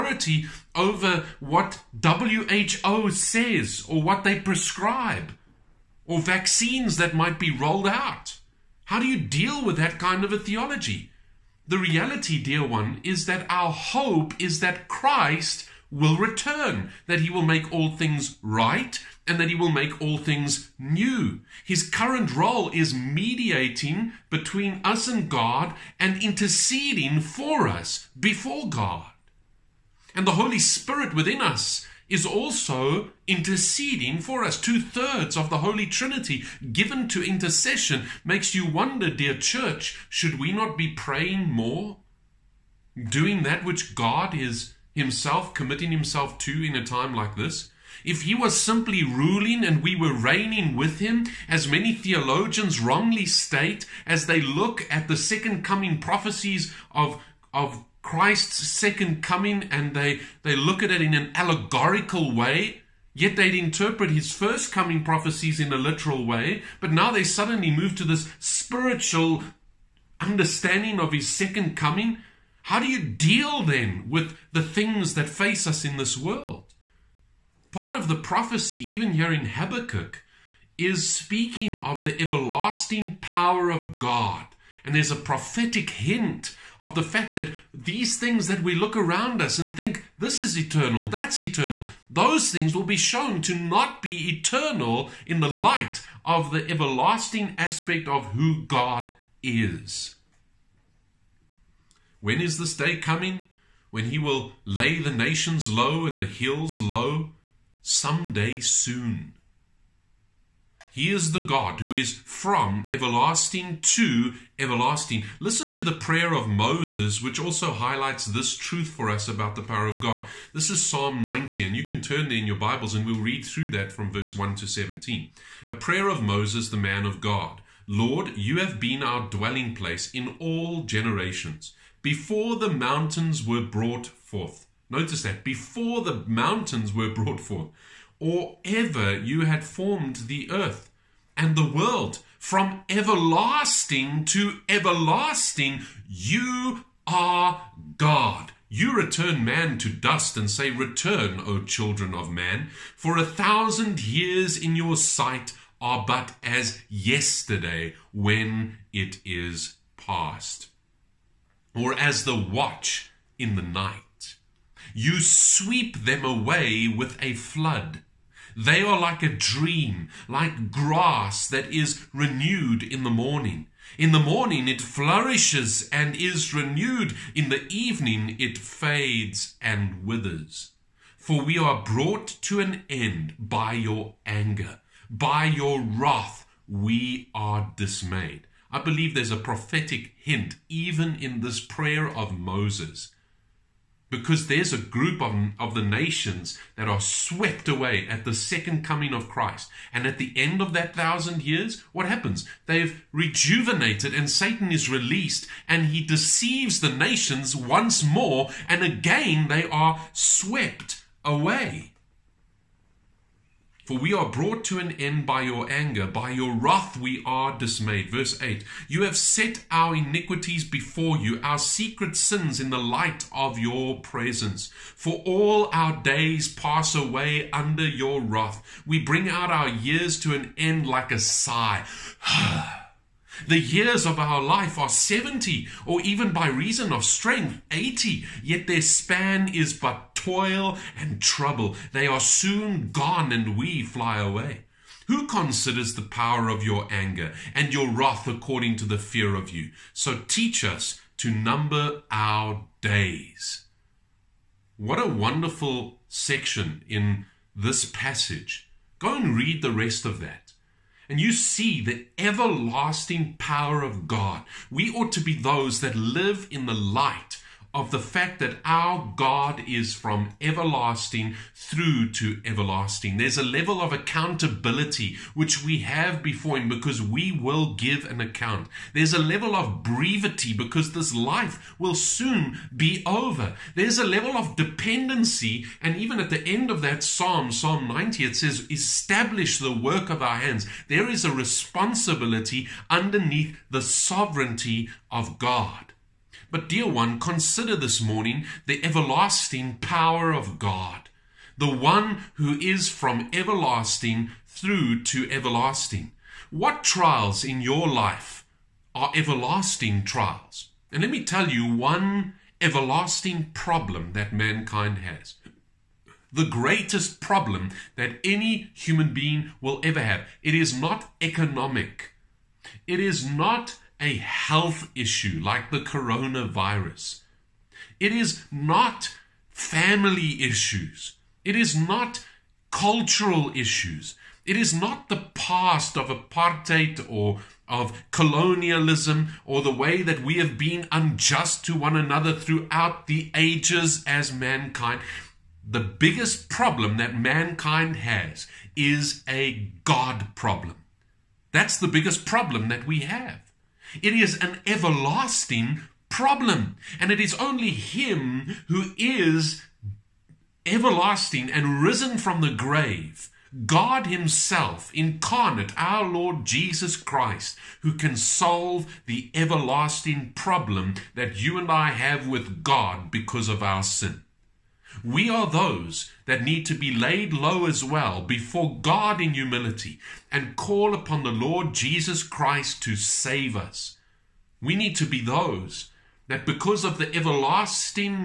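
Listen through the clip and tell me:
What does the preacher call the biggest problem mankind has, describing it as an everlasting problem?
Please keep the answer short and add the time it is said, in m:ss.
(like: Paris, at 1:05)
A God problem, at 5:49.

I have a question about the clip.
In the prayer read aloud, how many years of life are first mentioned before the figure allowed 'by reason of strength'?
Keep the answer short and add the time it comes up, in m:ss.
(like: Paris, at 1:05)
70, at 3:54.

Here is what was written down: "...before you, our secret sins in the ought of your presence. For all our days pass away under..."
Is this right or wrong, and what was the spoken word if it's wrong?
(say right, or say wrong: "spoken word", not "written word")
wrong: "light", not "ought".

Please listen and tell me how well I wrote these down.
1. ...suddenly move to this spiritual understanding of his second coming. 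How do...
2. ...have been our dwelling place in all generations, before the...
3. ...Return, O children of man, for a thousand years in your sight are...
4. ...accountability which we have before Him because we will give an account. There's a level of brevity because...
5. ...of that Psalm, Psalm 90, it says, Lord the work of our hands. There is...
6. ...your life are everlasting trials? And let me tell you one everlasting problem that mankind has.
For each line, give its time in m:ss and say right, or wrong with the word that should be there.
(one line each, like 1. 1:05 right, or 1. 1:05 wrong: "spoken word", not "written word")
1. 1:07 right
2. 2:08 right
3. 2:30 right
4. 4:33 right
5. 4:46 wrong: "Establish", not "Lord"
6. 5:07 right.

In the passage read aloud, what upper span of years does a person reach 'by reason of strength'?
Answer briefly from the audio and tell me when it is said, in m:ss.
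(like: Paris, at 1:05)
80, at 3:57.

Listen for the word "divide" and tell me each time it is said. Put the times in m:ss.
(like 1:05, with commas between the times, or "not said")
not said.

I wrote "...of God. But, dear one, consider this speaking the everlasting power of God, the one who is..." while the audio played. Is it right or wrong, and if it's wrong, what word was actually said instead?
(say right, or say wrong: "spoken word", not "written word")
wrong: "morning", not "speaking".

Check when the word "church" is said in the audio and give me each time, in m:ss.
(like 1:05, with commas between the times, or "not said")
0:39.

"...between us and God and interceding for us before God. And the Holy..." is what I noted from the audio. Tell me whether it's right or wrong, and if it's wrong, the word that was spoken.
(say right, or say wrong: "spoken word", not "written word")
right.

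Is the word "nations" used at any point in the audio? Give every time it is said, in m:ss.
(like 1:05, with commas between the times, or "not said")
1:45, 3:15, 3:26.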